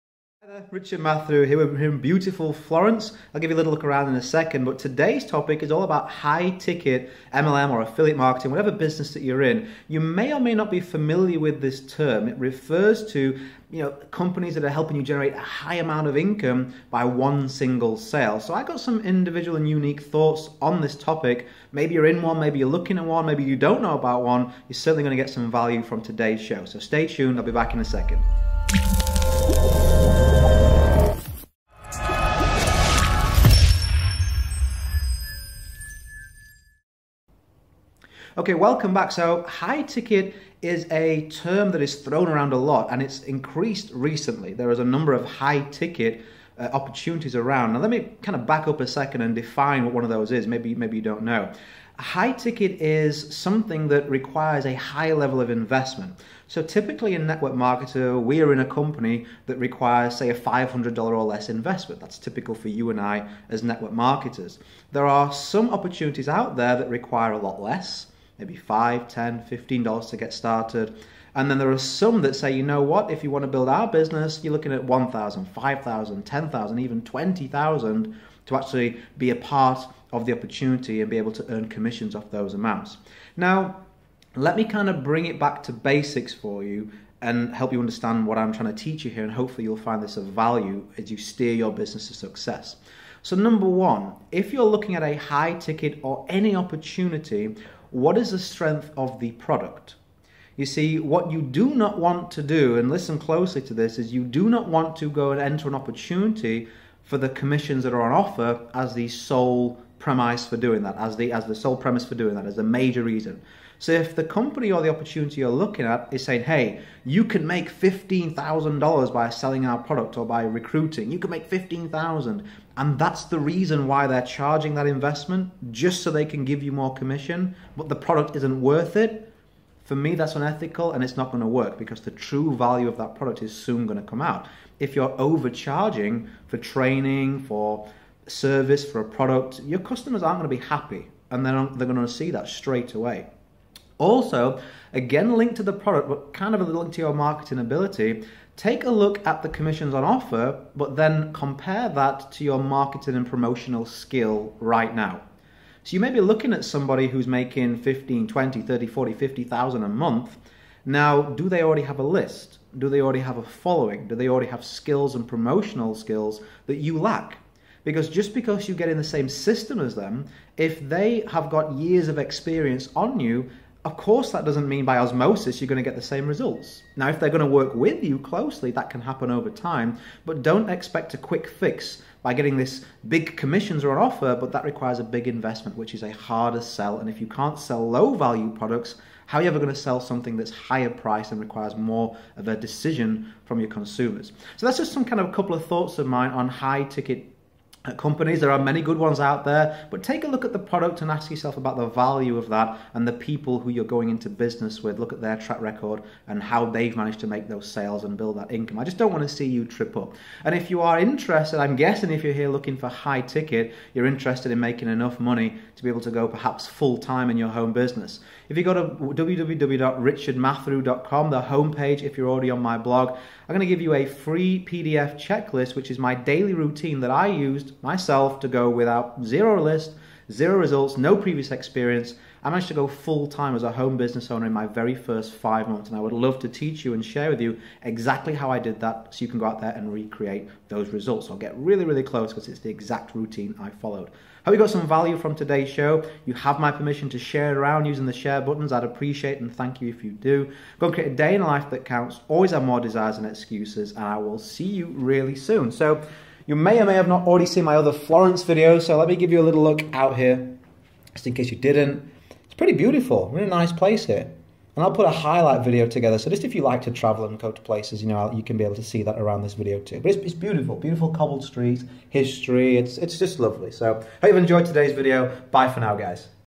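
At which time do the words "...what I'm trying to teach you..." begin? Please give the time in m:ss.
1:28.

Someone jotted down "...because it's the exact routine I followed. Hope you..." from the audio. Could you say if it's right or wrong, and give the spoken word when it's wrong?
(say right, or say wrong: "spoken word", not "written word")
right.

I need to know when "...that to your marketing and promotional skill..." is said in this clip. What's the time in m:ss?
2:31.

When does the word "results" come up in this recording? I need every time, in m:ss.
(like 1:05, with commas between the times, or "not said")
2:56, 3:50, 4:00.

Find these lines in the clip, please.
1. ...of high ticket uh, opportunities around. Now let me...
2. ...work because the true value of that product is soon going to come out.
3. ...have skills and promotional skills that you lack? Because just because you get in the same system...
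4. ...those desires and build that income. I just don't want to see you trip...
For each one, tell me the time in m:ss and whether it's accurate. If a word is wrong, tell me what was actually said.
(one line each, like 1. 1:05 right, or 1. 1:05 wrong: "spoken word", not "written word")
1. 0:45 right
2. 2:11 right
3. 2:44 right
4. 3:27 wrong: "sales", not "desires".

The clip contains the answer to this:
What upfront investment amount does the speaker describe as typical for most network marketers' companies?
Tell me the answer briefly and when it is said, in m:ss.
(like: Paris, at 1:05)
$500 or less, at 1:00.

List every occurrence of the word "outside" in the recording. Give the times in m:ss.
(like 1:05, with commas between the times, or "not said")
not said.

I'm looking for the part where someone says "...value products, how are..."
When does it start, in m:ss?
3:08.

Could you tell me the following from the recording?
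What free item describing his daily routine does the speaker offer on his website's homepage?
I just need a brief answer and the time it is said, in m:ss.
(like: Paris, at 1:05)
PDF checklist, at 3:44.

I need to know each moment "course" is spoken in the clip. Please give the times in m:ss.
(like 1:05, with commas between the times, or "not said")
2:53.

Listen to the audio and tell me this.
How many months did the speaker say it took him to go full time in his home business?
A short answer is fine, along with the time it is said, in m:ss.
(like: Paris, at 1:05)
5, at 3:55.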